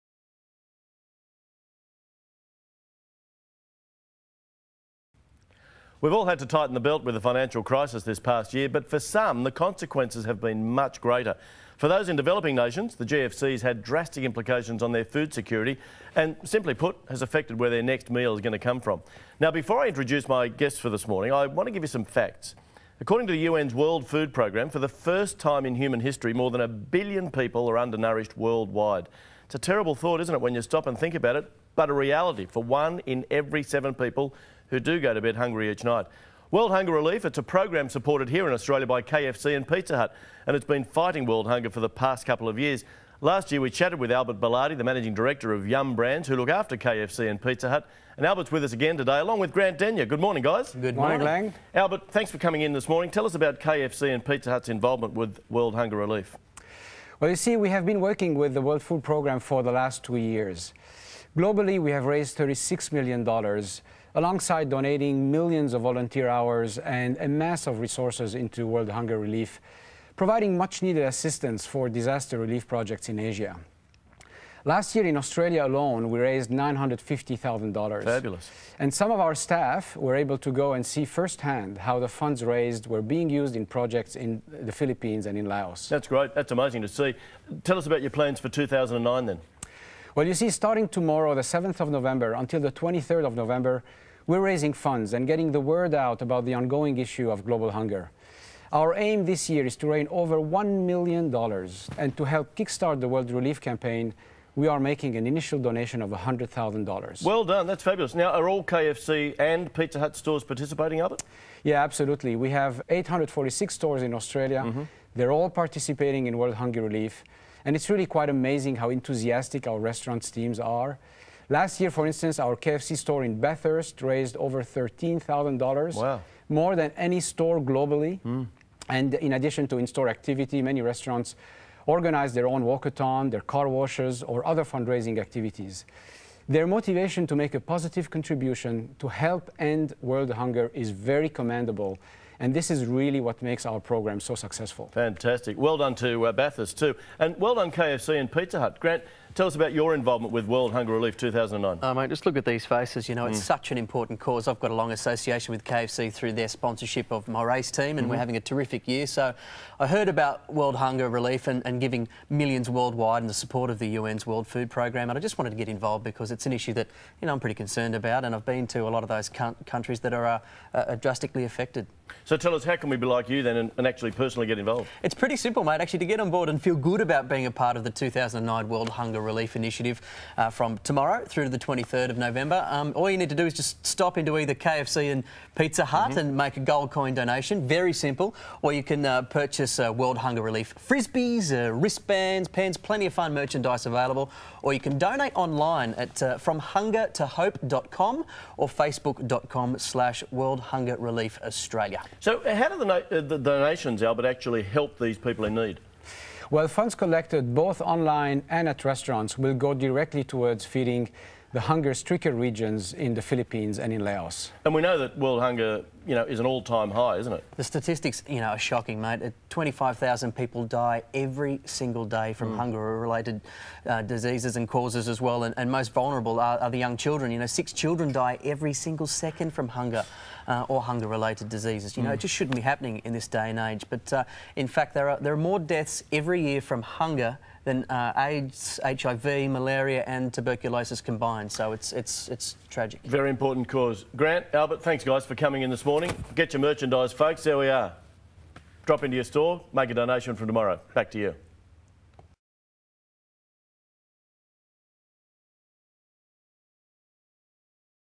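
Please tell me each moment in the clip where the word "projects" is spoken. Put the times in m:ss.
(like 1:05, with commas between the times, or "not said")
1:12, 1:23.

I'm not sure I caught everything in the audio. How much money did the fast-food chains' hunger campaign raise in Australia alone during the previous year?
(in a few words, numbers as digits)
$950,000.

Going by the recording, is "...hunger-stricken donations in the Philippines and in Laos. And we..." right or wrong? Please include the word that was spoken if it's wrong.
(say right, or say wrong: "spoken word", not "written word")
wrong: "regions", not "donations".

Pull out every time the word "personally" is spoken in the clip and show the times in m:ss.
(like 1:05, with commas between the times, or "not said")
2:54.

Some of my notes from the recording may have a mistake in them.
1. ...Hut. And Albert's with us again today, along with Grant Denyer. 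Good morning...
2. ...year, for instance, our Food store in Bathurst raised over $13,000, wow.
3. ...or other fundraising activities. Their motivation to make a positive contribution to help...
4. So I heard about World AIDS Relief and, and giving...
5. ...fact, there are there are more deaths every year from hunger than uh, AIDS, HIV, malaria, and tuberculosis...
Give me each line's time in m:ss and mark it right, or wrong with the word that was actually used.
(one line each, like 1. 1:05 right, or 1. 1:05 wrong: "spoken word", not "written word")
1. 0:47 right
2. 2:01 wrong: "KFC", not "Food"
3. 2:14 right
4. 2:39 wrong: "Hunger", not "AIDS"
5. 3:54 right.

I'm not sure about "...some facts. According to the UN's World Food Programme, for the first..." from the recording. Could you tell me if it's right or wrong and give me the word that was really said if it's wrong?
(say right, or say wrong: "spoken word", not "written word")
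right.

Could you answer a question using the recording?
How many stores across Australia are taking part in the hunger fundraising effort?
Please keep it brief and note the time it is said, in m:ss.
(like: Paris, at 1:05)
846, at 1:52.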